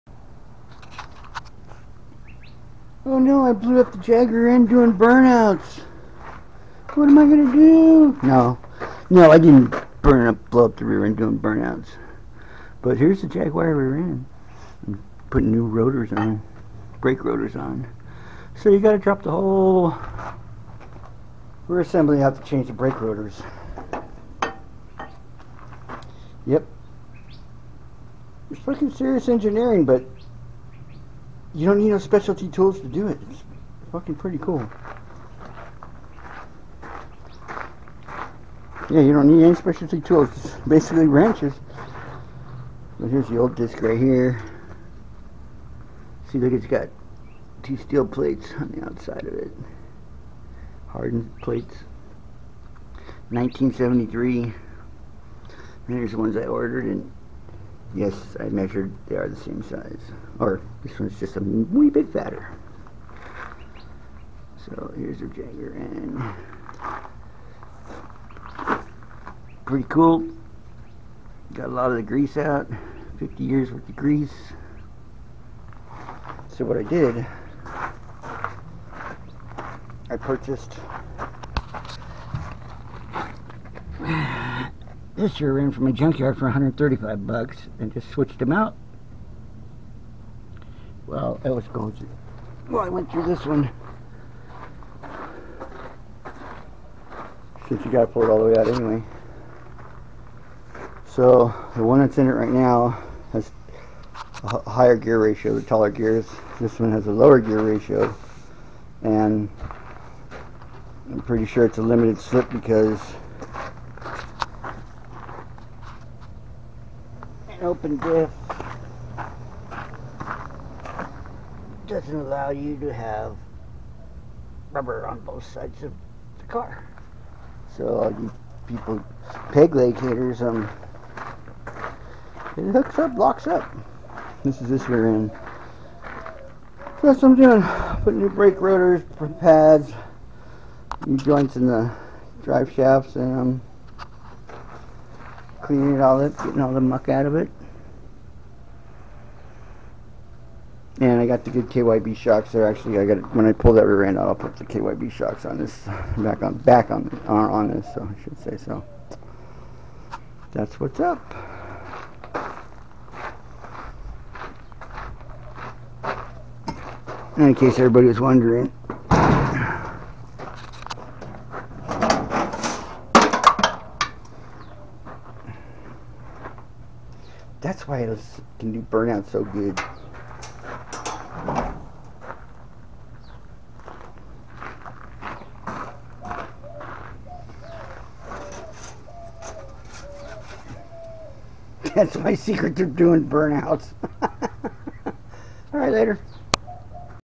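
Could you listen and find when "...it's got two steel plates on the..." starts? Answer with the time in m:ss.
0:46.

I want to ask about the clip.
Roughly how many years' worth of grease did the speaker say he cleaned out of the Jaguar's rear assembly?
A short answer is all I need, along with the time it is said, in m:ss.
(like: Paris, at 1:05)
50 years, at 1:13.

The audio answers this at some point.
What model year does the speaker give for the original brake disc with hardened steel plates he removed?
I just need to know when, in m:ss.
0:53.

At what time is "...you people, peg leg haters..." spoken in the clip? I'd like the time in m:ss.
2:08.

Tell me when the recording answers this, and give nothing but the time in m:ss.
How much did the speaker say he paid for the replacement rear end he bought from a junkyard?
1:26.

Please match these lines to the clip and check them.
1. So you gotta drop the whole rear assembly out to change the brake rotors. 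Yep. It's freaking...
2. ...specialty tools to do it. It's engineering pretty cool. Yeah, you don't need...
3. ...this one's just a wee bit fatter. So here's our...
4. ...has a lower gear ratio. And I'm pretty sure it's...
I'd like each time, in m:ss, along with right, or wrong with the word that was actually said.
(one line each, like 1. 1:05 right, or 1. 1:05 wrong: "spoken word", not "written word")
1. 0:18 right
2. 0:31 wrong: "fucking", not "engineering"
3. 1:00 right
4. 1:46 right.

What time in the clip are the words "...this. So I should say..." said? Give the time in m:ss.
2:37.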